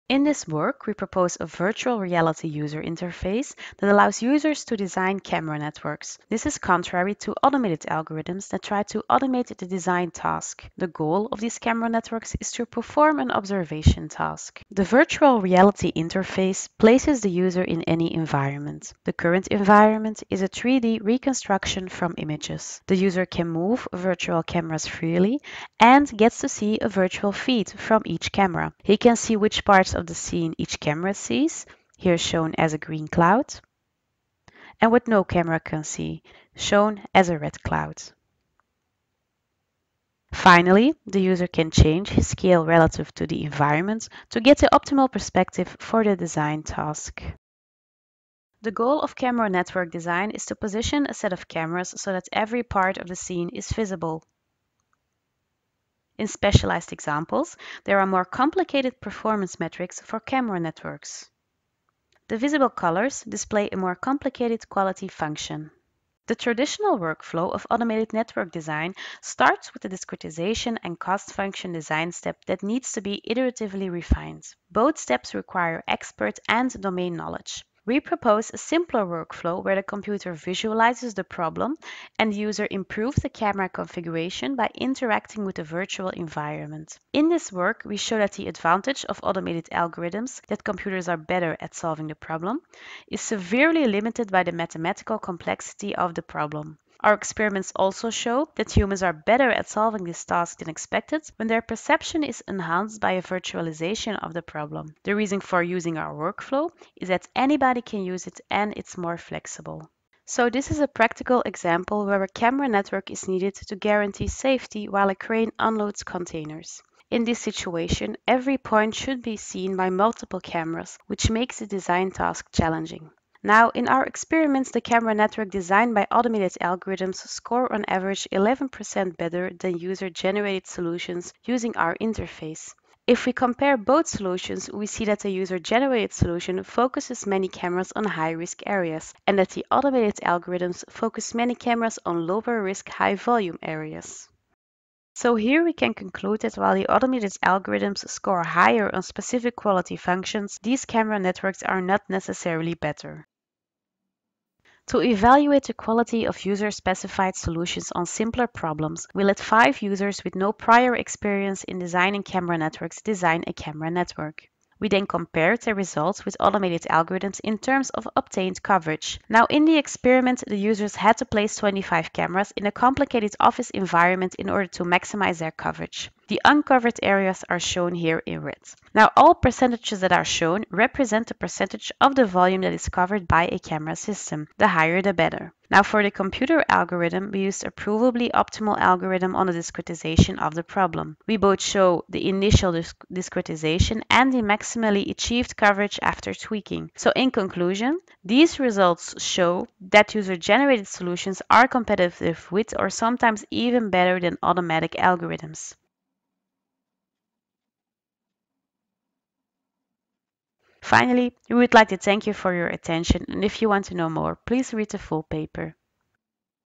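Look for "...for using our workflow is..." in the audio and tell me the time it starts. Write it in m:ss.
1:45.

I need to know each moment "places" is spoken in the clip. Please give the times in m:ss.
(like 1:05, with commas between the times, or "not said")
0:16, 2:51.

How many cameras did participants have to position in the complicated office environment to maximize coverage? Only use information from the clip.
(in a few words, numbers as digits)
25.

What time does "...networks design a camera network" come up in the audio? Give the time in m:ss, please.
2:42.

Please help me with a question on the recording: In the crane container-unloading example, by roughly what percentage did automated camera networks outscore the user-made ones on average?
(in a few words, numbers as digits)
11%.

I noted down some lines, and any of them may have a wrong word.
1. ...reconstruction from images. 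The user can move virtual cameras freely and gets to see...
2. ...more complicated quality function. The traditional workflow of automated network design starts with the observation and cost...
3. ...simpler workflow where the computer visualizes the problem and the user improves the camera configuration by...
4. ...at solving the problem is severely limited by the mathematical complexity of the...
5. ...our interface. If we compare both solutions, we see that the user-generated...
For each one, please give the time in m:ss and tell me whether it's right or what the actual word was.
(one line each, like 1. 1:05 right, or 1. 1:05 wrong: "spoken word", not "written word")
1. 0:21 right
2. 1:03 wrong: "discretization", not "observation"
3. 1:18 right
4. 1:31 right
5. 2:11 right.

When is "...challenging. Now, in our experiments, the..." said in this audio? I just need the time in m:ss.
2:02.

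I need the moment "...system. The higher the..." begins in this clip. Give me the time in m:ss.
3:03.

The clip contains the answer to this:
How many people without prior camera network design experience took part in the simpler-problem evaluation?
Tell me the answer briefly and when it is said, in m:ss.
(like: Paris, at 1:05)
5, at 2:39.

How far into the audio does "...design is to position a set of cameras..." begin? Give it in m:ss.
0:49.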